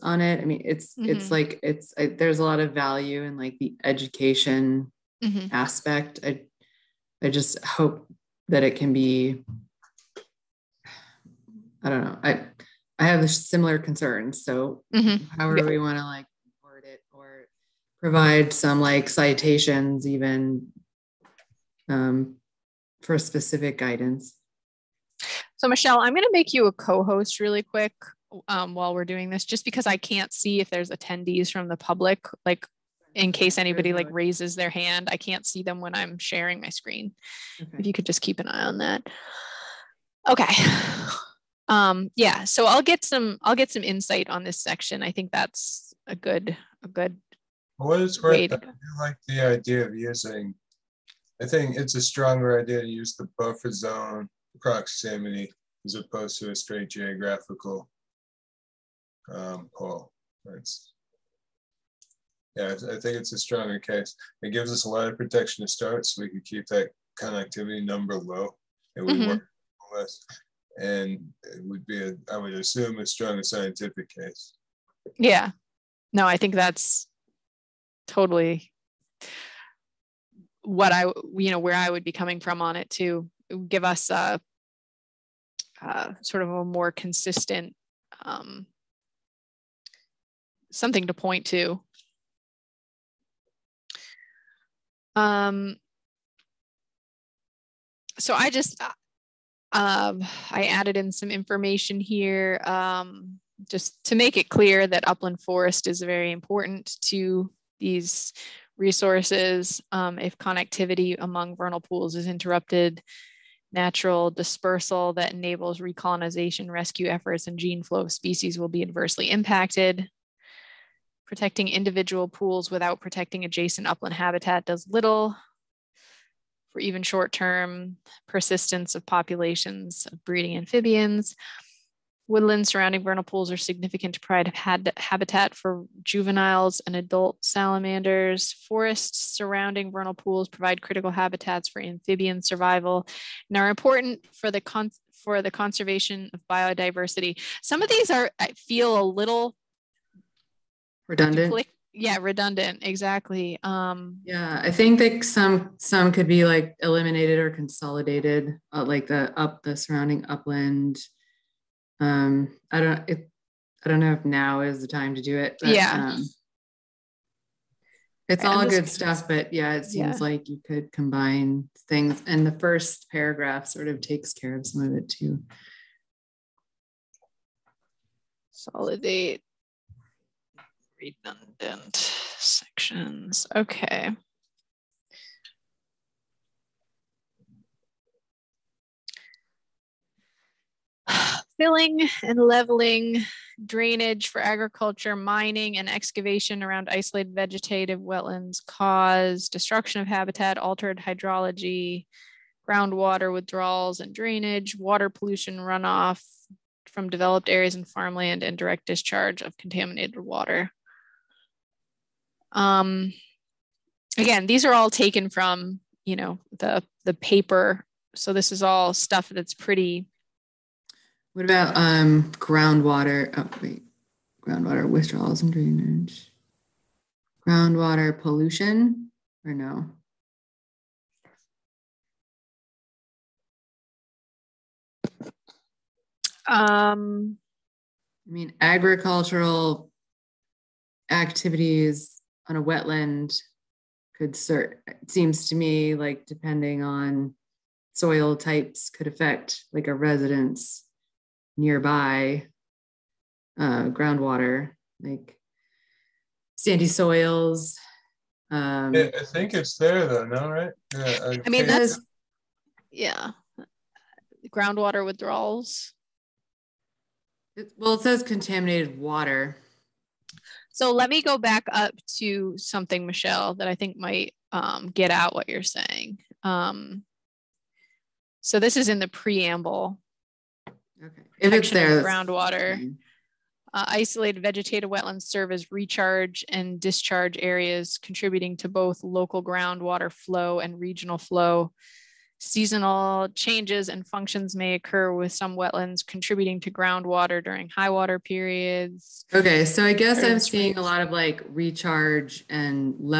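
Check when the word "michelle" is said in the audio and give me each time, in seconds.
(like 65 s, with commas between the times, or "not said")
25 s, 273 s.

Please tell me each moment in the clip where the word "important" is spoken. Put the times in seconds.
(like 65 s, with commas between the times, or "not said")
106 s, 143 s.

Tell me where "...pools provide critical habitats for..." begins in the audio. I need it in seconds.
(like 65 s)
140 s.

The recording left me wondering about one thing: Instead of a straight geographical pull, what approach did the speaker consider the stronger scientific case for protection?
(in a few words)
buffer zone proximity.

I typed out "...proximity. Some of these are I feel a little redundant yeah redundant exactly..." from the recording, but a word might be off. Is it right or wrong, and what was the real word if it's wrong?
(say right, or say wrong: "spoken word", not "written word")
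wrong: "biodiversity", not "proximity".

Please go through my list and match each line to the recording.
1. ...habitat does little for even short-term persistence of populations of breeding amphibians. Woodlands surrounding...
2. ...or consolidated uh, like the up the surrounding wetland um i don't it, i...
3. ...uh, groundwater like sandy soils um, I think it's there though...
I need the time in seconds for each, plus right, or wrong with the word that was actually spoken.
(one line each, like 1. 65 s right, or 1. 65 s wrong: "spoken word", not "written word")
1. 124 s right
2. 157 s wrong: "upland", not "wetland"
3. 253 s right.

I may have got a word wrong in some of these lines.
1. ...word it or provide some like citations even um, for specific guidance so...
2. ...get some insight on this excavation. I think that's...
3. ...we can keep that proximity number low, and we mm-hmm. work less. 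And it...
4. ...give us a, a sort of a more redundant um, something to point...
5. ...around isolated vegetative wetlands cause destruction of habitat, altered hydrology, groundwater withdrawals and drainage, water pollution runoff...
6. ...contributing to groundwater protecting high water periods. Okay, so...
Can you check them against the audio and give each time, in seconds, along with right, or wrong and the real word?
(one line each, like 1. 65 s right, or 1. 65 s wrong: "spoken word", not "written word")
1. 16 s right
2. 43 s wrong: "section", not "excavation"
3. 66 s wrong: "connectivity", not "proximity"
4. 83 s wrong: "consistent", not "redundant"
5. 196 s right
6. 296 s wrong: "during", not "protecting".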